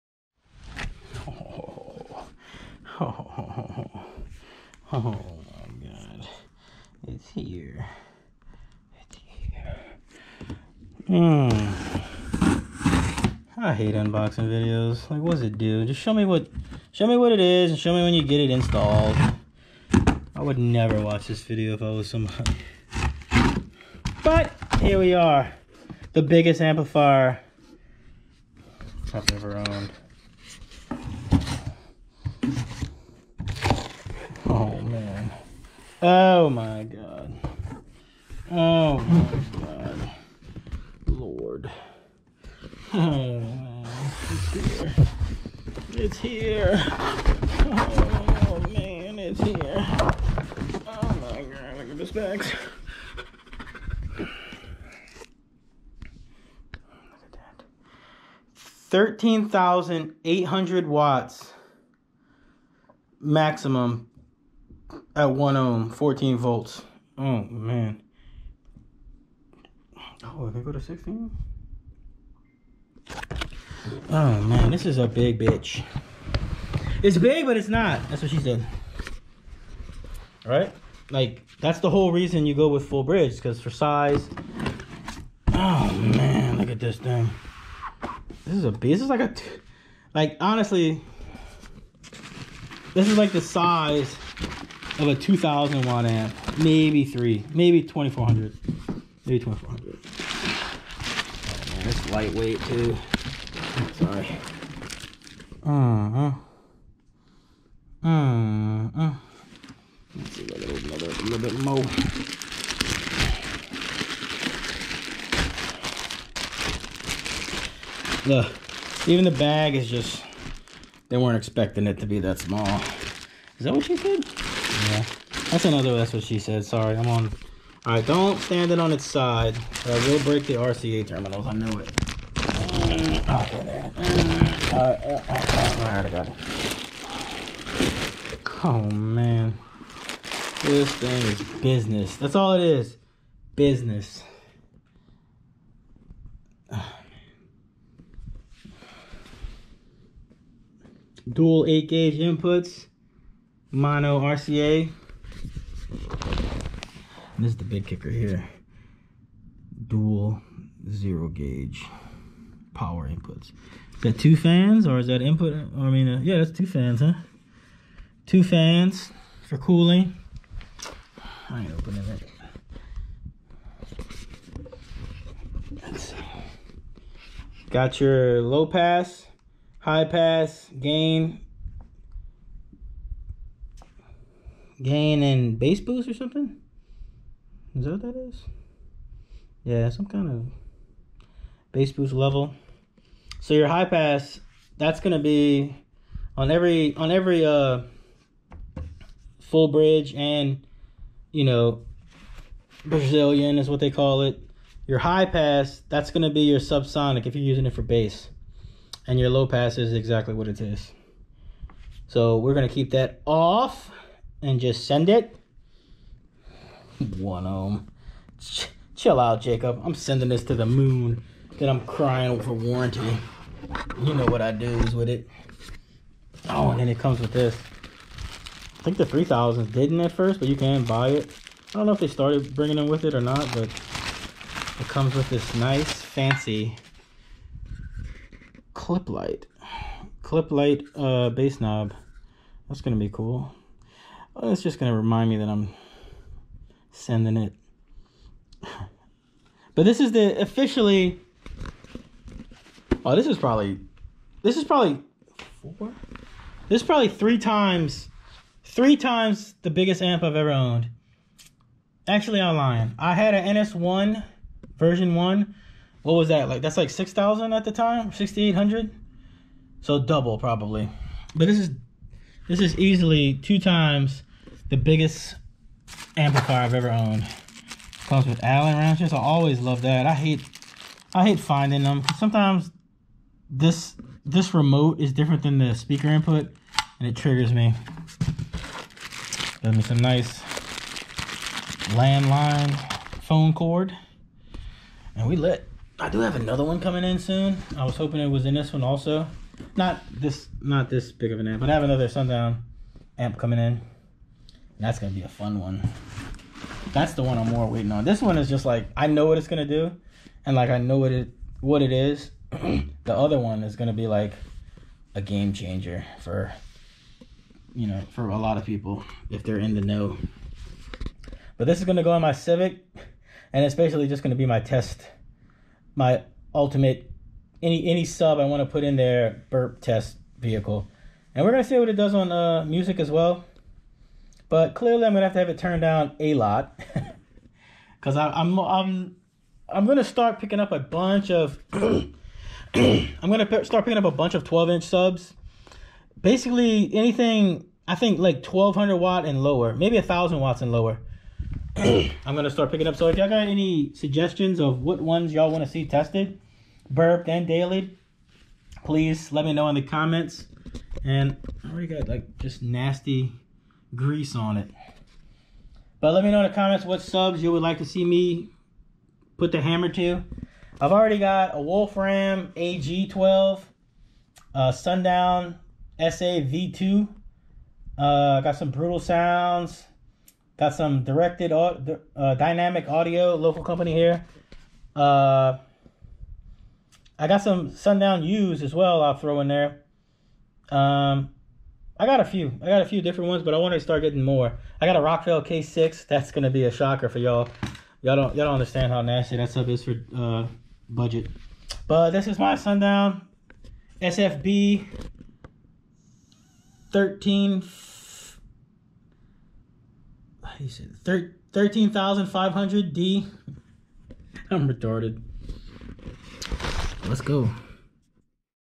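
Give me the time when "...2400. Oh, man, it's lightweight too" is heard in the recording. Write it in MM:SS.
01:39.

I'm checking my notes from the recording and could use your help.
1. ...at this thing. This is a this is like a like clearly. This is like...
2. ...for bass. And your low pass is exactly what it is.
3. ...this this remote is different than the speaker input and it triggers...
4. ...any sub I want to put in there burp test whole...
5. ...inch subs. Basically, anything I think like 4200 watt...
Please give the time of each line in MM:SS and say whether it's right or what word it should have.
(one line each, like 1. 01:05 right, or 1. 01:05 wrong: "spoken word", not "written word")
1. 01:26 wrong: "honestly", not "clearly"
2. 03:27 right
3. 04:43 right
4. 05:27 wrong: "vehicle", not "whole"
5. 05:44 wrong: "1200", not "4200".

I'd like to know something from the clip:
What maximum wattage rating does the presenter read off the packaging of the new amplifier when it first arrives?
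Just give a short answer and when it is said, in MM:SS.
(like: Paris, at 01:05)
13,800 watts, at 00:58.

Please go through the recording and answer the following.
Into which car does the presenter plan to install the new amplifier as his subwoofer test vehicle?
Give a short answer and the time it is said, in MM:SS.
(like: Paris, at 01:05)
Civic, at 05:22.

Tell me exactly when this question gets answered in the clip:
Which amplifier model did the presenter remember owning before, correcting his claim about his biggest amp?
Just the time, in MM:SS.
04:23.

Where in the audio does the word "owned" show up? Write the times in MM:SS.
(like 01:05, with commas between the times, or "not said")
00:29, 04:20, 04:36.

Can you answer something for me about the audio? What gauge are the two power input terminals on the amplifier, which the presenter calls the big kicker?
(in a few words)
Zero gauge.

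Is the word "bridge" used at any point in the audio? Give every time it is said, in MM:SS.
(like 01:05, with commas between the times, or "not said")
01:23, 03:19.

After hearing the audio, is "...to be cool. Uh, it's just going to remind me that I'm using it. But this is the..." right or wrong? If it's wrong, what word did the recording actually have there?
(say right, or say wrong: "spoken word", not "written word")
wrong: "sending", not "using".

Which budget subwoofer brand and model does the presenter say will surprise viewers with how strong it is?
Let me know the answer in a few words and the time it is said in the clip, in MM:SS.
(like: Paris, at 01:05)
Rockville K6, at 06:35.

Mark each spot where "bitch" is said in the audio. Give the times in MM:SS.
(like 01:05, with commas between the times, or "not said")
01:15.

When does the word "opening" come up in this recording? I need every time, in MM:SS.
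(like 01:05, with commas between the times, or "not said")
02:51.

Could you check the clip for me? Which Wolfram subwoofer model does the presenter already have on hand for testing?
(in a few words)
AG12.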